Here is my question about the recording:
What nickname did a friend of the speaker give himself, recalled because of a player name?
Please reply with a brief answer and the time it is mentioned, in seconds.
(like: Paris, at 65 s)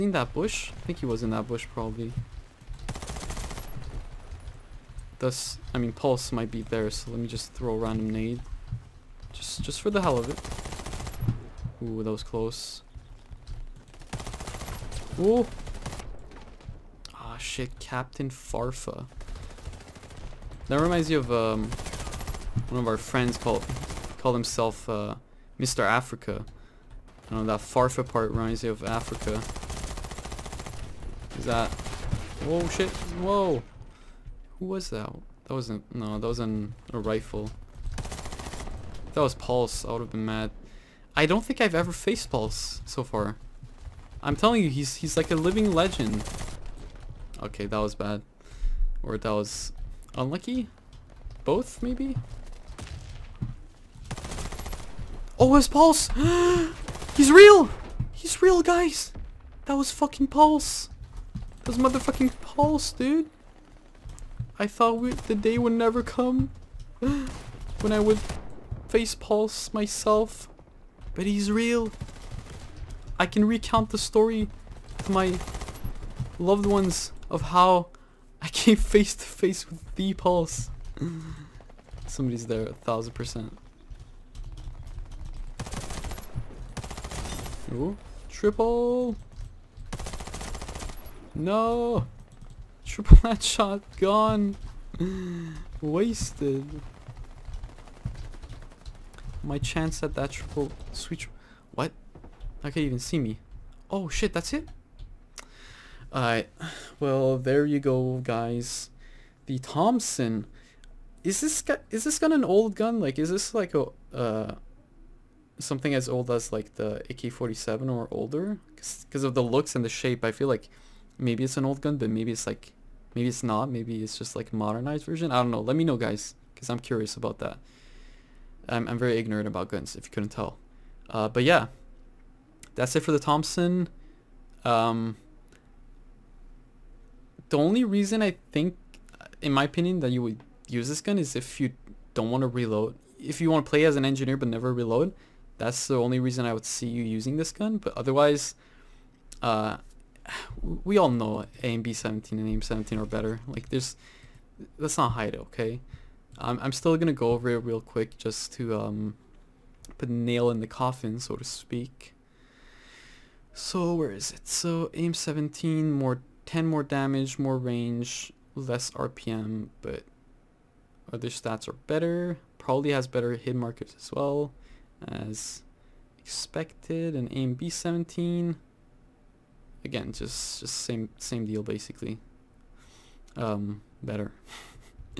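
Mr. Africa, at 25 s.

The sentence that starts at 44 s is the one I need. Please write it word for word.
I'm telling you, he's he's like a living legend.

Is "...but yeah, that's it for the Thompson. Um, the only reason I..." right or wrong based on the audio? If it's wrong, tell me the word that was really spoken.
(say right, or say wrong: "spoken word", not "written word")
right.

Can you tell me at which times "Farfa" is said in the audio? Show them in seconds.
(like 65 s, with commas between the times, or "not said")
18 s, 27 s.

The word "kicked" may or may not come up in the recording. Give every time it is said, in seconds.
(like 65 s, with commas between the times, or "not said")
not said.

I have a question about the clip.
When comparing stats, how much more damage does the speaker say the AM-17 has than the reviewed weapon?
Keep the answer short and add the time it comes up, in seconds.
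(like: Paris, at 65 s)
10, at 166 s.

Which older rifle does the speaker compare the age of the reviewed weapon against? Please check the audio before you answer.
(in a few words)
AK-47.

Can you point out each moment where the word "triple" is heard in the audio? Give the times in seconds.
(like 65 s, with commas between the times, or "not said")
88 s, 92 s, 100 s.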